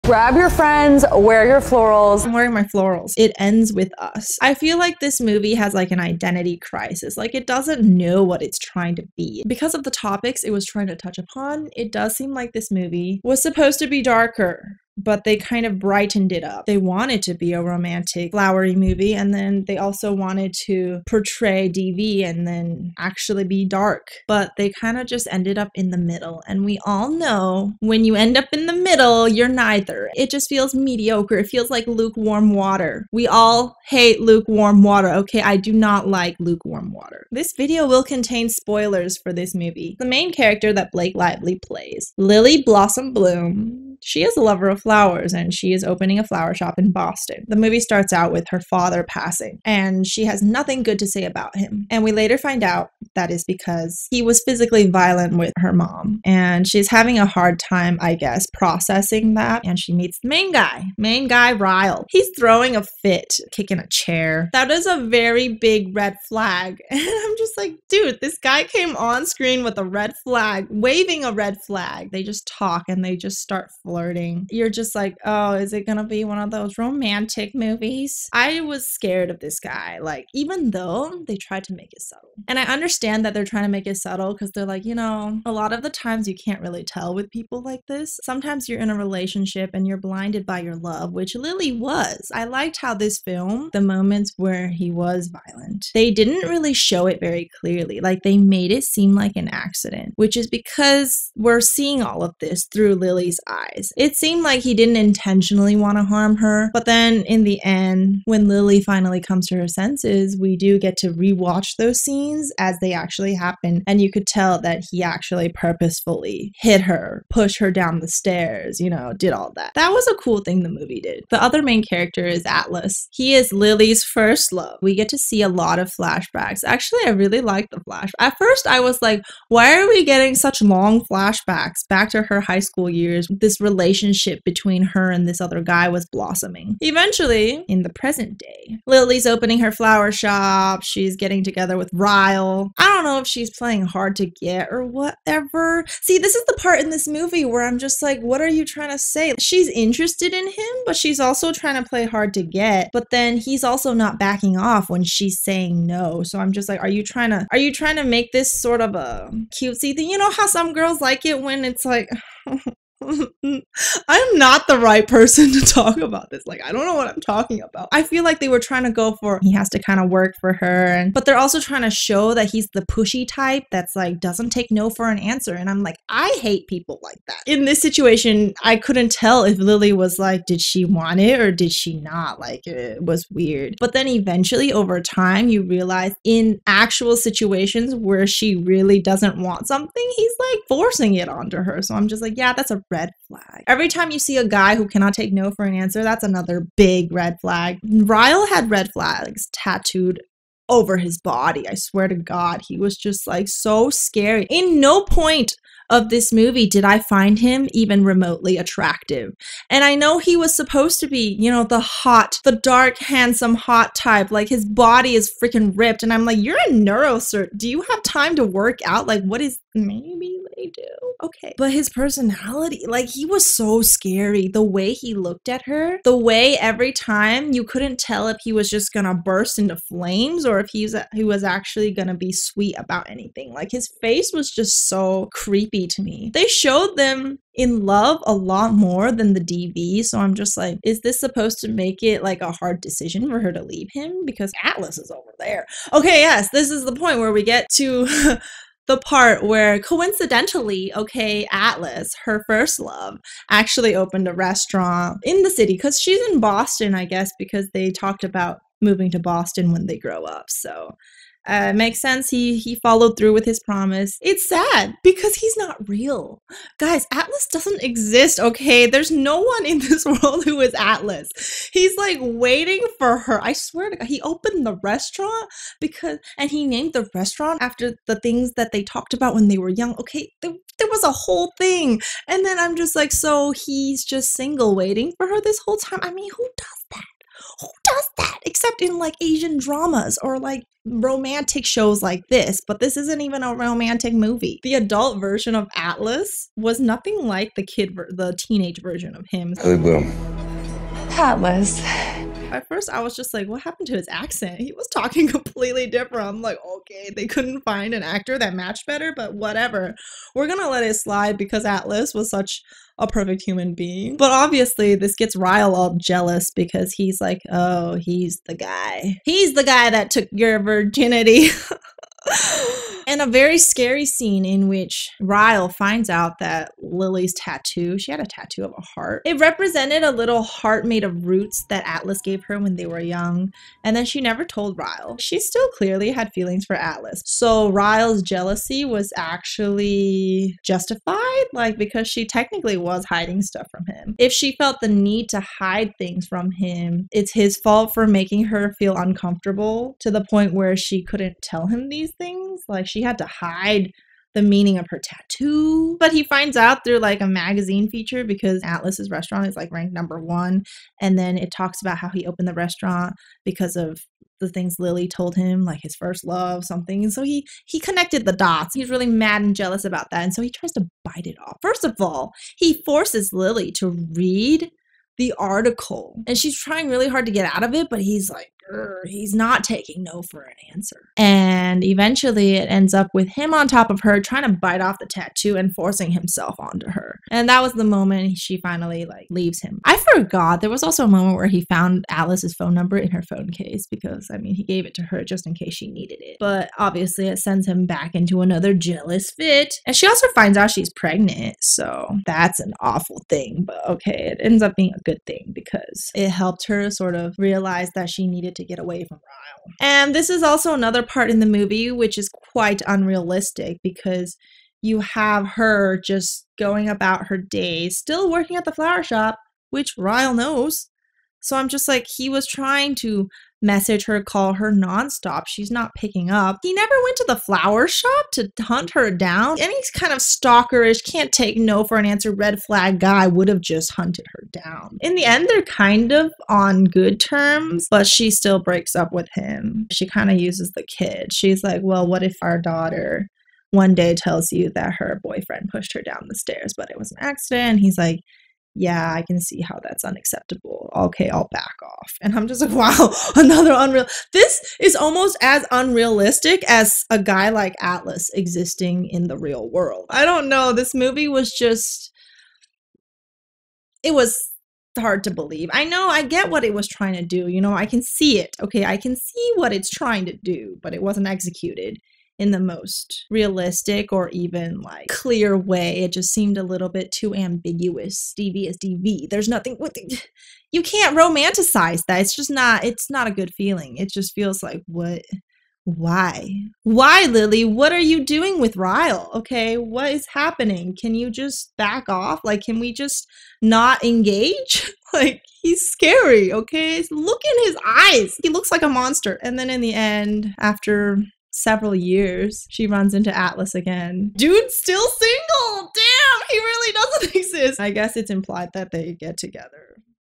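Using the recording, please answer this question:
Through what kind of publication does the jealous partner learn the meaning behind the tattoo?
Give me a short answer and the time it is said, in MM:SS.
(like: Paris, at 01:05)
A magazine, at 05:57.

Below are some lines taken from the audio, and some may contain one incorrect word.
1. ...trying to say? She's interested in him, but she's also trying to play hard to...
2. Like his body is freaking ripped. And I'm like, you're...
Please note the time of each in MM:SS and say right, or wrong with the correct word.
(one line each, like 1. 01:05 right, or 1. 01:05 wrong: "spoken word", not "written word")
1. 02:28 right
2. 03:34 right.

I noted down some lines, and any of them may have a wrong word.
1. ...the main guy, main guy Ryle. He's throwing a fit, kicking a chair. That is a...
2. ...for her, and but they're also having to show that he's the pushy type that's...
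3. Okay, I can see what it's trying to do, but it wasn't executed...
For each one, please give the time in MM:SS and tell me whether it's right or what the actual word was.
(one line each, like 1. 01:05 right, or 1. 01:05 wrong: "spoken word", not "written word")
1. 01:00 right
2. 02:50 wrong: "trying", not "having"
3. 07:48 right.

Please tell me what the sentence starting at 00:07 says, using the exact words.
Like it doesn't know what it's trying to be.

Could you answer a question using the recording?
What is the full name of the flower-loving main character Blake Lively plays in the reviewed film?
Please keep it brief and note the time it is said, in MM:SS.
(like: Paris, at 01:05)
Lily Blossom Bloom, at 00:42.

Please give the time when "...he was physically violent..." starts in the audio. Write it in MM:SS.
00:54.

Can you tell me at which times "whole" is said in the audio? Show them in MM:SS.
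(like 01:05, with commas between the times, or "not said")
04:41, 04:45.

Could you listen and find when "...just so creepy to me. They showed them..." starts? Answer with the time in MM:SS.
03:54.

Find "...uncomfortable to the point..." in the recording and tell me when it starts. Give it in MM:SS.
05:48.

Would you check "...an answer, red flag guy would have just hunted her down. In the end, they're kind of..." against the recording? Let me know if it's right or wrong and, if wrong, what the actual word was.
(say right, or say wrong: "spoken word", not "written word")
right.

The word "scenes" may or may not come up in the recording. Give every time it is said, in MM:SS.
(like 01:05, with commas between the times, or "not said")
01:52, 05:24.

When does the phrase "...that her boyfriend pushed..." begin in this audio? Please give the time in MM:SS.
07:24.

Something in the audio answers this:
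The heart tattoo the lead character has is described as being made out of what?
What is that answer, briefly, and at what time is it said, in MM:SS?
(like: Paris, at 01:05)
Roots, at 05:31.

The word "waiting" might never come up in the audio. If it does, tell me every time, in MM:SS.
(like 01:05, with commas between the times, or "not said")
04:32, 04:44.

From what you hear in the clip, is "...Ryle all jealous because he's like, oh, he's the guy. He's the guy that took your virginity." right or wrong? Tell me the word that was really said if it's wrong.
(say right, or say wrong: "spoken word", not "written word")
right.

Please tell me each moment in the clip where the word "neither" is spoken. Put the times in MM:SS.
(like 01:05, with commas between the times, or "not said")
00:29.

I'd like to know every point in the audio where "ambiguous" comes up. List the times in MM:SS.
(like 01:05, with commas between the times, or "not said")
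07:57.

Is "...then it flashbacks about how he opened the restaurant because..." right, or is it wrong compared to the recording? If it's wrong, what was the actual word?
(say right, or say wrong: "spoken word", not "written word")
wrong: "talks", not "flashbacks".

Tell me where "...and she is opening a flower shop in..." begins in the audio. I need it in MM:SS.
00:45.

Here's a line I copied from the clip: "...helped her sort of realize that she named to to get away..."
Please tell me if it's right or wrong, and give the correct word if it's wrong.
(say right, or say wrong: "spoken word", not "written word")
wrong: "needed", not "named".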